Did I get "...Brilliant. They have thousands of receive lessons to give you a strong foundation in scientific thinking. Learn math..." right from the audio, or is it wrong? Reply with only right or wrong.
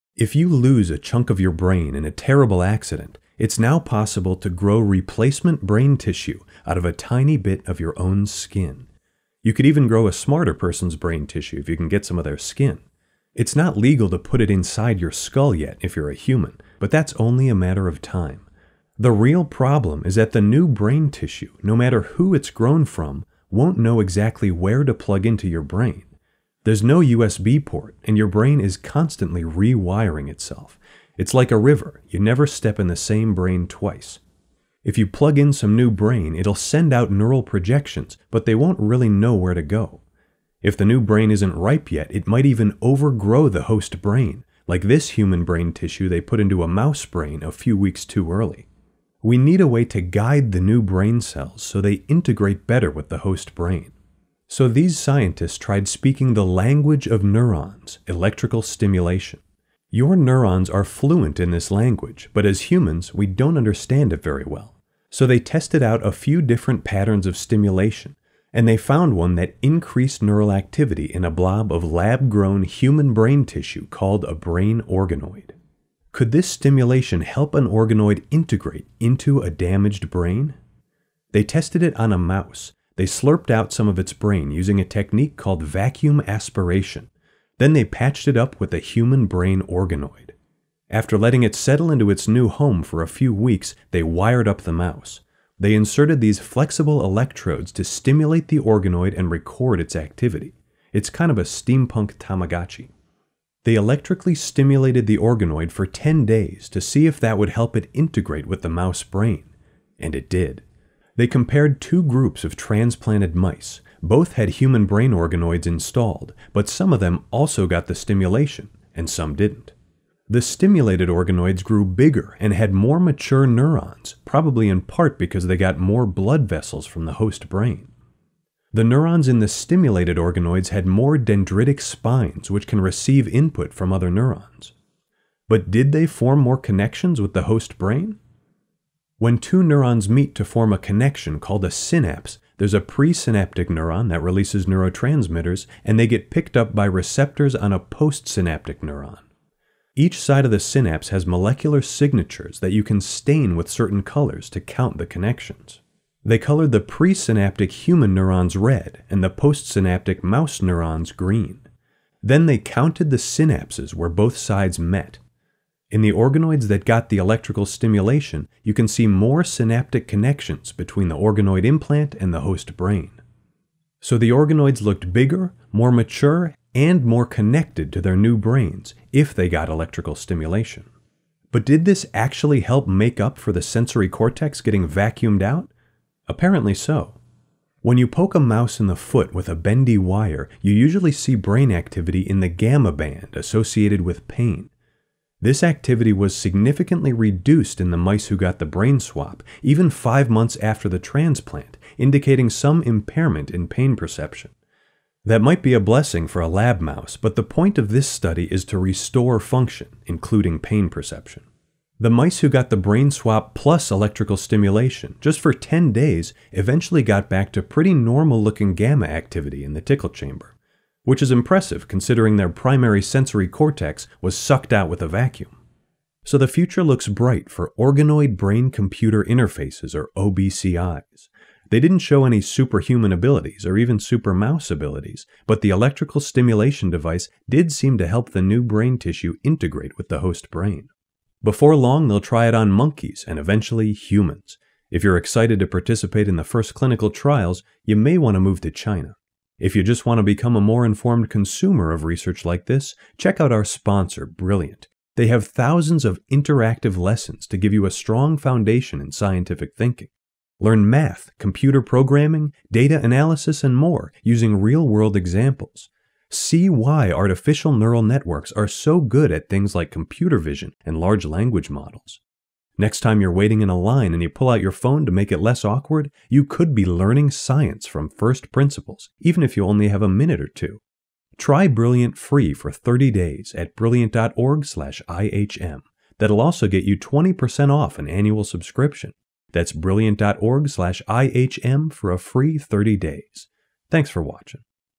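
wrong.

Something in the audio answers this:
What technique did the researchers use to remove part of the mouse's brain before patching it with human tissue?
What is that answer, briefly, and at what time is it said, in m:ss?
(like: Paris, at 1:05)
Vacuum aspiration, at 1:25.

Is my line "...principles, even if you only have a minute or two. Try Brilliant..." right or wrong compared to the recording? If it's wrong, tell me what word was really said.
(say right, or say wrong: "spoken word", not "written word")
right.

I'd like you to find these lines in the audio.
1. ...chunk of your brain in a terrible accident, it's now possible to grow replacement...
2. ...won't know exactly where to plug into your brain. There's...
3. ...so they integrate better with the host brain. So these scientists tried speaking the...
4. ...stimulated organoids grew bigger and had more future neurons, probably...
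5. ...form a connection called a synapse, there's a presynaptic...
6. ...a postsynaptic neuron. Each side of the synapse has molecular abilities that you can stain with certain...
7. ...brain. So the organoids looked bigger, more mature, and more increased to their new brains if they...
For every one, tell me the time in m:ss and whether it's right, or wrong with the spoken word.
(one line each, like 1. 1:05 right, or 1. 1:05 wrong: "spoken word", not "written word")
1. 0:00 right
2. 0:23 right
3. 0:51 right
4. 2:00 wrong: "mature", not "future"
5. 2:20 right
6. 2:27 wrong: "signatures", not "abilities"
7. 2:52 wrong: "connected", not "increased".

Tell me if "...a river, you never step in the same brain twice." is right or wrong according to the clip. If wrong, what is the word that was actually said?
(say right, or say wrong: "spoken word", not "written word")
right.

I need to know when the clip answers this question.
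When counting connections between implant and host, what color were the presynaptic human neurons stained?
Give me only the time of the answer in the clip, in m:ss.
2:38.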